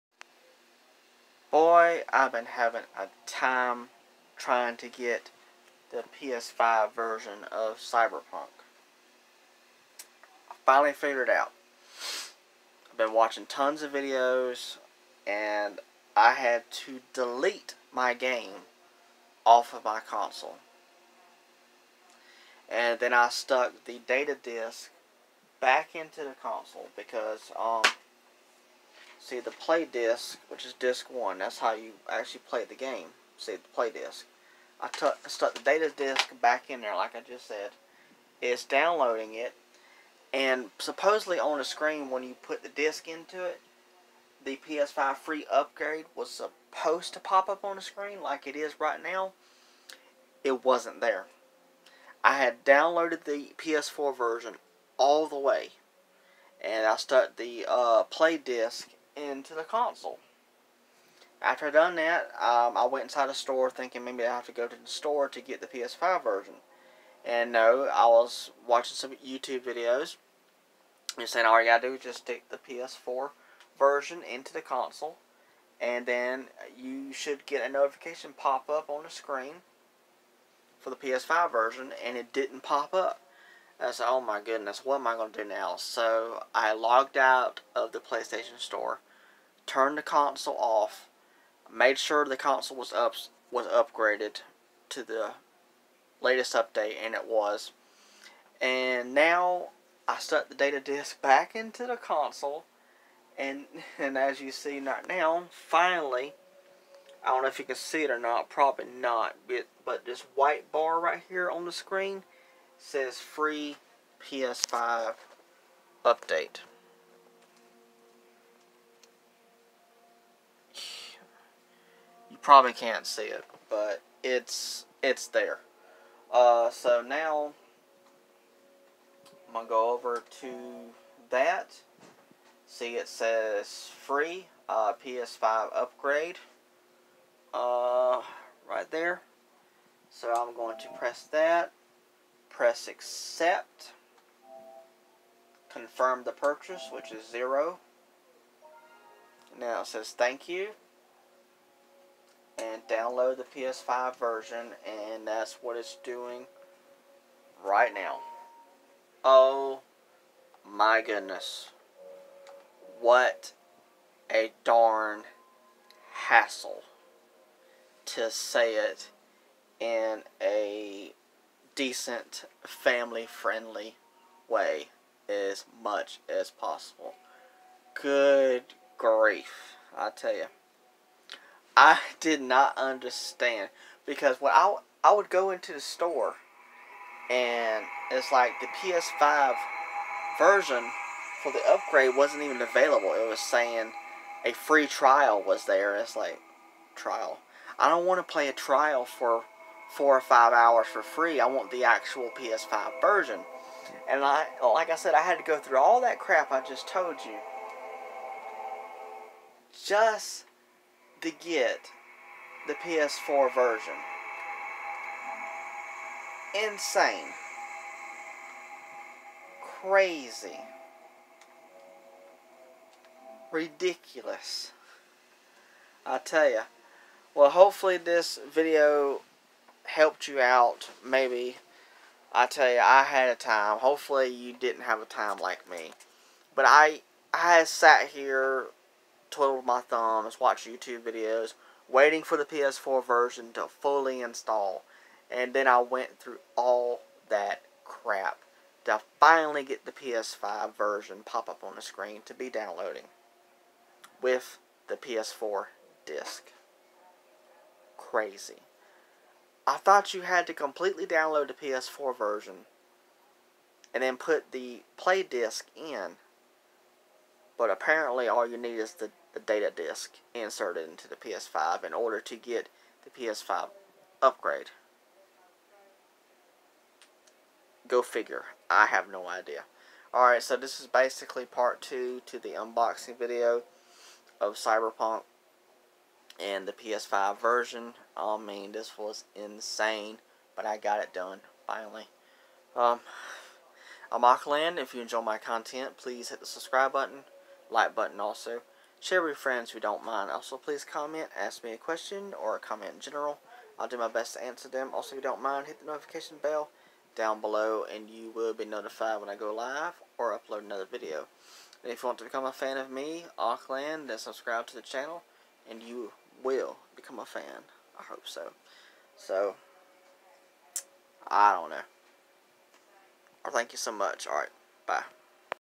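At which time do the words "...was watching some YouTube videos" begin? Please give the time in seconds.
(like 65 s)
68 s.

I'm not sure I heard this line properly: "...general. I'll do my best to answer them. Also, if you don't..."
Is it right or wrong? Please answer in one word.
right.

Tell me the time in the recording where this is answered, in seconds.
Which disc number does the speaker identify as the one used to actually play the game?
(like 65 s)
30 s.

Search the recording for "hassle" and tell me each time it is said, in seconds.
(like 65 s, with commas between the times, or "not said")
166 s.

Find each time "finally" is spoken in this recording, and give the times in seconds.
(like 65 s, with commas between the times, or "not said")
10 s, 105 s, 249 s, 291 s.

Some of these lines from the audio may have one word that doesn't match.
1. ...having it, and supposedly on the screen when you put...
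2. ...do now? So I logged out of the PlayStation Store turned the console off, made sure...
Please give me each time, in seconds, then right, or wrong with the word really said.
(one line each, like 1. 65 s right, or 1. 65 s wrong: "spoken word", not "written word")
1. 38 s wrong: "downloading", not "having"
2. 85 s right.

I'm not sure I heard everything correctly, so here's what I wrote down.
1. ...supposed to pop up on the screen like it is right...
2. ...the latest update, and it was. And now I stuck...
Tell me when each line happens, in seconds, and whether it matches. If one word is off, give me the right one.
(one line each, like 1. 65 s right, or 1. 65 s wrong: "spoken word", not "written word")
1. 46 s right
2. 95 s right.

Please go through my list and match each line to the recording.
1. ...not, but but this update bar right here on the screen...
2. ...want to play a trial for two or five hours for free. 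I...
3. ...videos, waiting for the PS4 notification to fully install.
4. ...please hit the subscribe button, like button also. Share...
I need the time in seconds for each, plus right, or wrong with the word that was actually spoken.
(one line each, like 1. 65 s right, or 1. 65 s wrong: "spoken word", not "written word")
1. 108 s wrong: "white", not "update"
2. 198 s wrong: "four", not "two"
3. 241 s wrong: "version", not "notification"
4. 295 s right.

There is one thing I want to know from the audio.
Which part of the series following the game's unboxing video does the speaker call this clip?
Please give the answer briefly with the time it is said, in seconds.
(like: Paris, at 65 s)
Part two, at 281 s.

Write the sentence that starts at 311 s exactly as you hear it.
And if you want to become a fan of me, Aqland, then subscribe to the channel, and you will become a fan.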